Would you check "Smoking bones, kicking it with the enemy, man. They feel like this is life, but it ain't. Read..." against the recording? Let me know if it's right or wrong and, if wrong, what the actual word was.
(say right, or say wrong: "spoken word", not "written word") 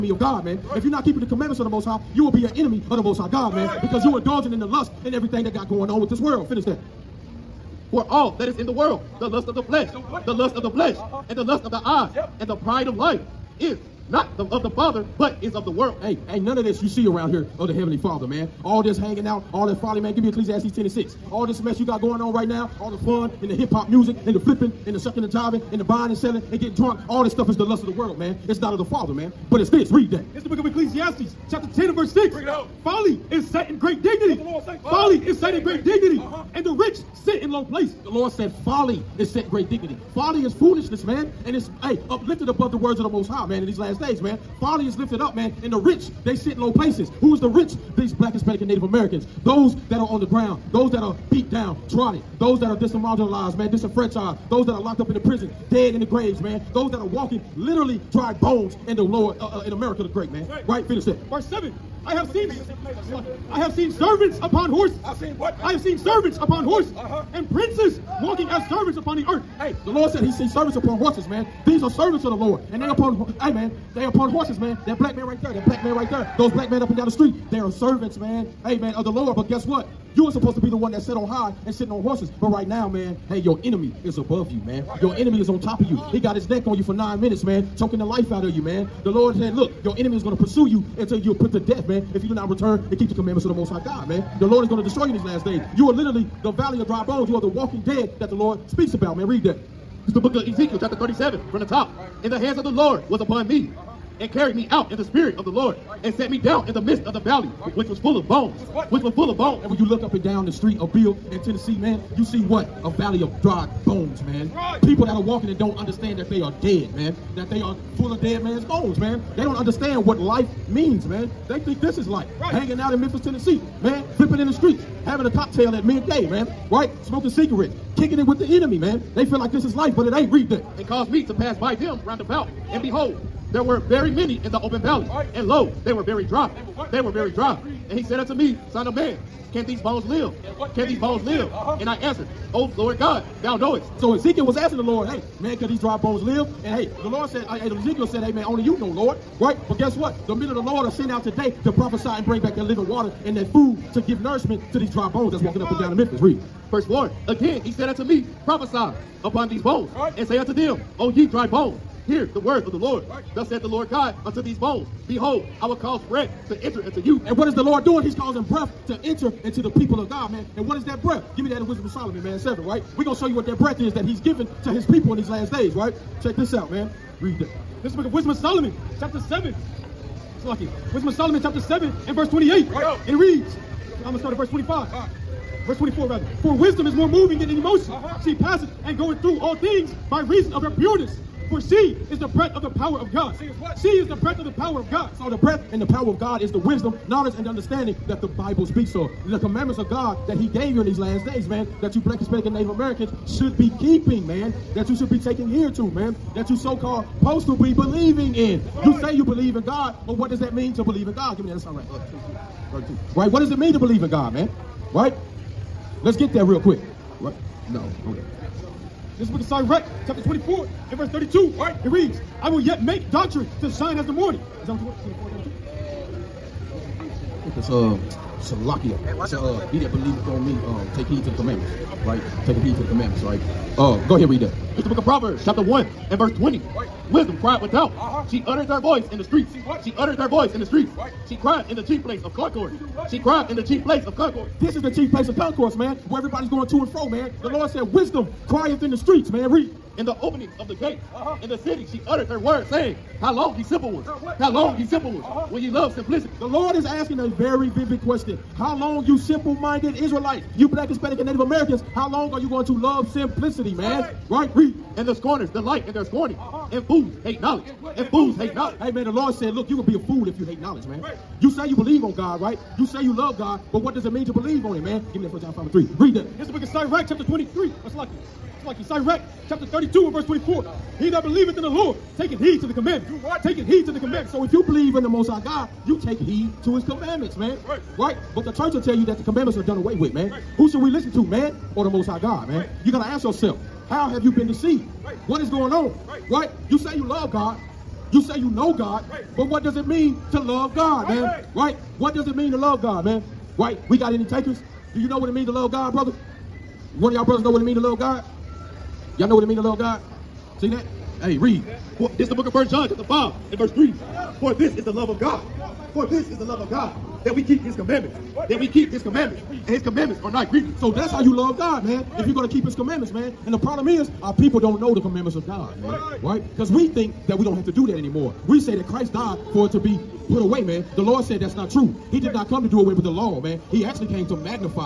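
wrong: "cigarettes", not "bones".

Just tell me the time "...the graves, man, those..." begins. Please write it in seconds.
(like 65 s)
55 s.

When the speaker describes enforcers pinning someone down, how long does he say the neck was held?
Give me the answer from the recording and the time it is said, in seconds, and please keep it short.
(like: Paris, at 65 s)
9 minutes, at 86 s.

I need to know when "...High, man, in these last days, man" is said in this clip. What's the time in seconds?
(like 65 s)
43 s.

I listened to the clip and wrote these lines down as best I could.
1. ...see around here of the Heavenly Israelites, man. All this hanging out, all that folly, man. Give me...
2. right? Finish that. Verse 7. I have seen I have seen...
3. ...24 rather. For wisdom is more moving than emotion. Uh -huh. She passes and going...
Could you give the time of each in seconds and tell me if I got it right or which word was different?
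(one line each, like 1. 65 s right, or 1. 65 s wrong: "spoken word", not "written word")
1. 16 s wrong: "Father", not "Israelites"
2. 60 s right
3. 185 s right.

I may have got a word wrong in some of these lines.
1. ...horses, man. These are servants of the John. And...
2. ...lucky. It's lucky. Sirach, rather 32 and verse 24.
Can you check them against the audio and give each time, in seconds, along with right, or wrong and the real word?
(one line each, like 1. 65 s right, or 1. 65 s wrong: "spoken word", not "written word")
1. 70 s wrong: "Lord", not "John"
2. 277 s wrong: "chapter", not "rather".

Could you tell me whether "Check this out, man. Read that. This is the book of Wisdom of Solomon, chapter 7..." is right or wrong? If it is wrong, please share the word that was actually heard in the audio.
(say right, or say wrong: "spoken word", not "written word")
right.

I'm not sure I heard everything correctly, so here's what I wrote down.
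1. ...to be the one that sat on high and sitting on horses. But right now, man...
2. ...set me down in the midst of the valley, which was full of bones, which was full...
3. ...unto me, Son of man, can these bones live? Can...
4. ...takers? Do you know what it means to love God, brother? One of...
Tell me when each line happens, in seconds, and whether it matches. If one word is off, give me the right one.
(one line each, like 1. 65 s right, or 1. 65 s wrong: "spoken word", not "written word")
1. 80 s right
2. 106 s right
3. 138 s right
4. 304 s right.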